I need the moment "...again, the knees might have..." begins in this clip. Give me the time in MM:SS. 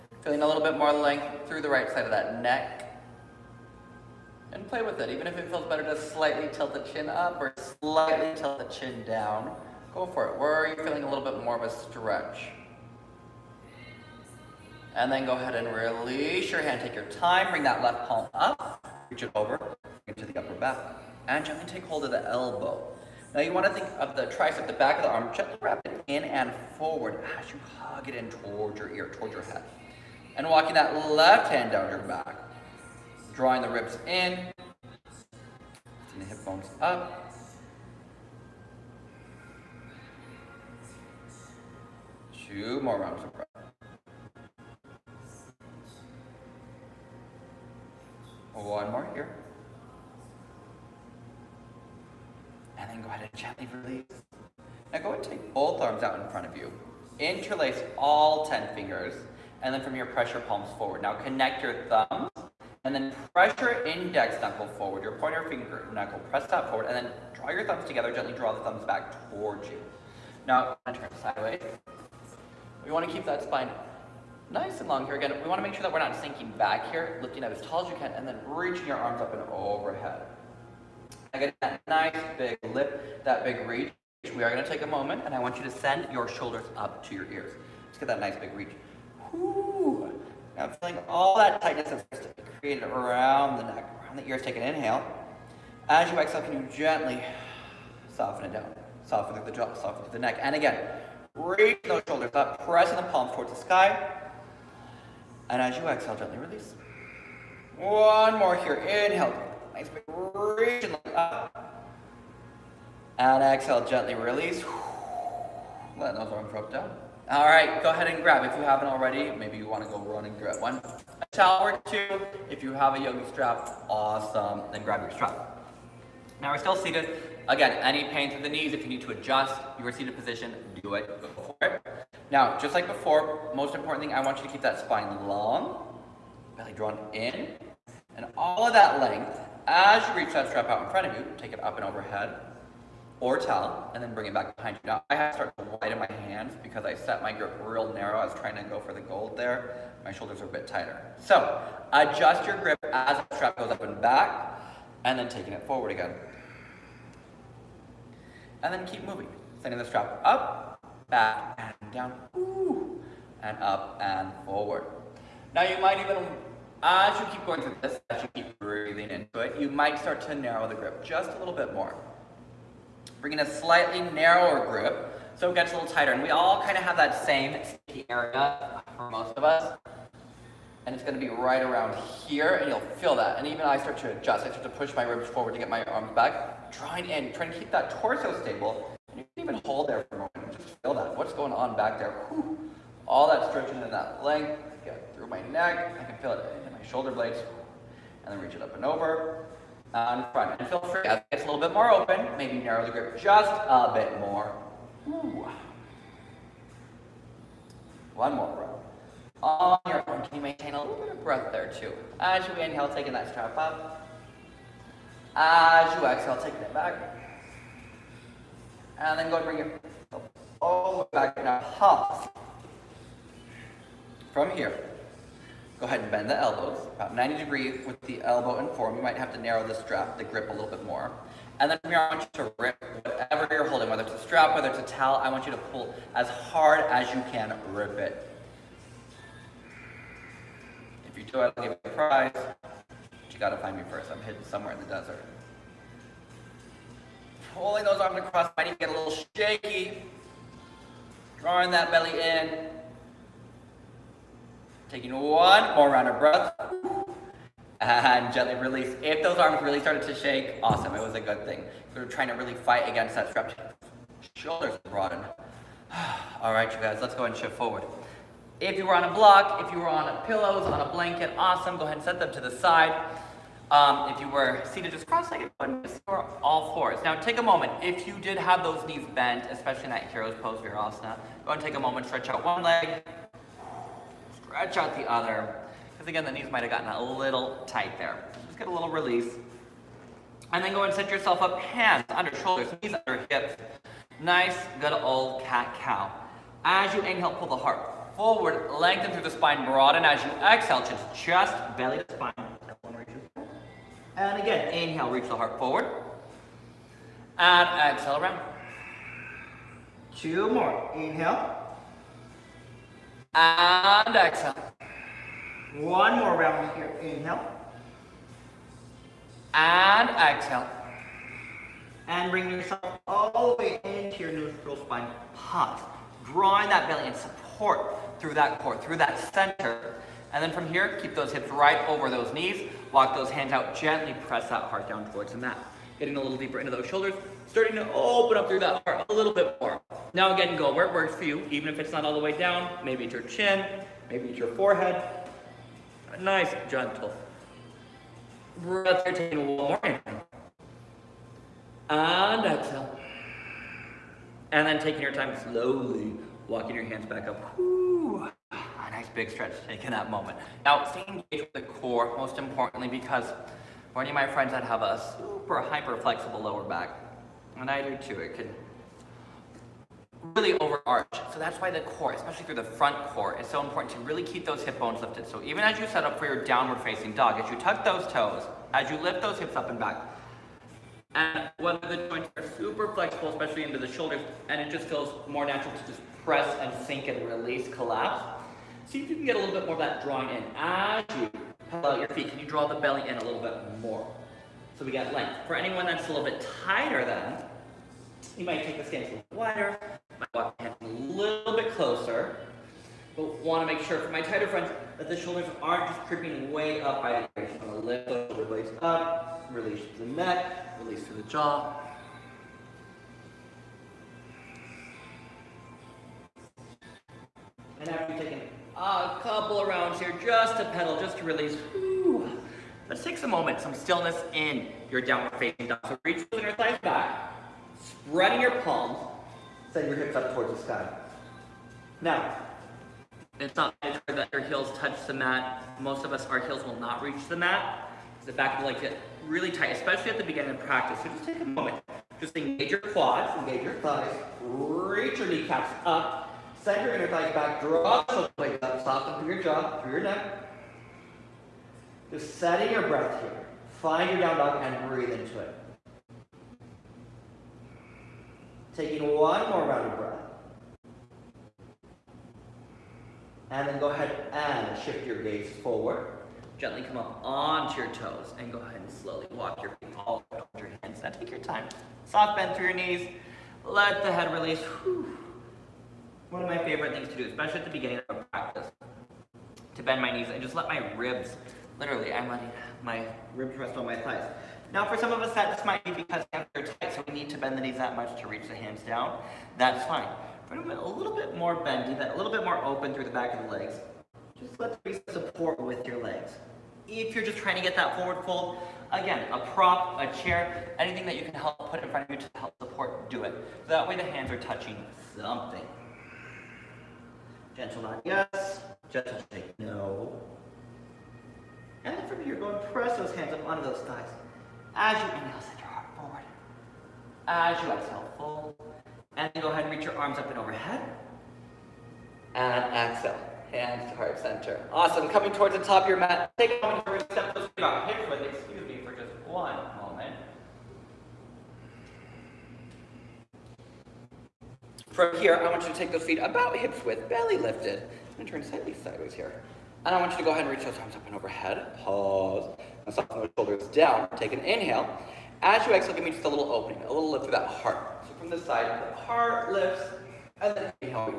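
04:46.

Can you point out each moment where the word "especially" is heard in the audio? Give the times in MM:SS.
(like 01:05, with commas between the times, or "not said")
04:39, 06:12, 06:23, 07:19, 07:57.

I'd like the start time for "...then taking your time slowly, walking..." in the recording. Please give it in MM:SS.
05:54.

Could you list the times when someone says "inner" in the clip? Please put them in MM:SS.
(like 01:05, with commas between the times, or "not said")
07:06, 07:26.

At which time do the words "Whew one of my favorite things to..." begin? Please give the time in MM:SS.
07:54.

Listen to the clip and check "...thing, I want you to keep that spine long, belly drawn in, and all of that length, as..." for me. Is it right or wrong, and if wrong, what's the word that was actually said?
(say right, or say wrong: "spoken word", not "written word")
right.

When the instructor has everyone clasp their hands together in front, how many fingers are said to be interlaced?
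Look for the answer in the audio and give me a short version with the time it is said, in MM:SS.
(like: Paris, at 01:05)
10, at 00:58.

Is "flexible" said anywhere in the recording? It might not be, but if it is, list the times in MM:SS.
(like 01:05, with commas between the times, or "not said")
06:05, 06:22.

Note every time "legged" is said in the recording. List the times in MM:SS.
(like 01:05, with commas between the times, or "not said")
04:35.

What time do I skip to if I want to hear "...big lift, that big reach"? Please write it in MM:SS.
01:22.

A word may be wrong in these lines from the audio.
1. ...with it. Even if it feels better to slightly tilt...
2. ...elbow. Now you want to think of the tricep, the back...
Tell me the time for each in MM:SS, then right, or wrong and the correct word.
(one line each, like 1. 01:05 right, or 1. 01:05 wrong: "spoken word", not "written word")
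1. 00:04 right
2. 00:22 right.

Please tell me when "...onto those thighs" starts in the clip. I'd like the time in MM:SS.
08:33.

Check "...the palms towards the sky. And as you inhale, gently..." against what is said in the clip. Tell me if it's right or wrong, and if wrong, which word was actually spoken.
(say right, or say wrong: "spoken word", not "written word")
wrong: "exhale", not "inhale".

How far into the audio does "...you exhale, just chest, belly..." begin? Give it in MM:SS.
05:00.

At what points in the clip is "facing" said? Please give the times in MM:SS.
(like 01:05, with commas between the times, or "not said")
06:16, 07:05.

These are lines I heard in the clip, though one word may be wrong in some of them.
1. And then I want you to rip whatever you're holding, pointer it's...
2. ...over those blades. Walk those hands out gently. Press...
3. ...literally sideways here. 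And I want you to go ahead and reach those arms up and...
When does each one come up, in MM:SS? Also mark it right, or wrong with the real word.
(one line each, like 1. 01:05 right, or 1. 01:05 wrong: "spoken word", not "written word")
1. 03:51 wrong: "whether", not "pointer"
2. 05:31 wrong: "knees", not "blades"
3. 08:58 wrong: "slightly", not "literally".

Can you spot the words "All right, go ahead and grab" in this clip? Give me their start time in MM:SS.
01:57.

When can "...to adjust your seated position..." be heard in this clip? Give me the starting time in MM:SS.
02:09.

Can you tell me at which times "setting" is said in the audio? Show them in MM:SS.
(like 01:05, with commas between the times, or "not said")
07:32.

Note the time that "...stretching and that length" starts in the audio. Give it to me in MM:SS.
03:13.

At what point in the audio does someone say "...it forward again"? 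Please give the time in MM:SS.
02:35.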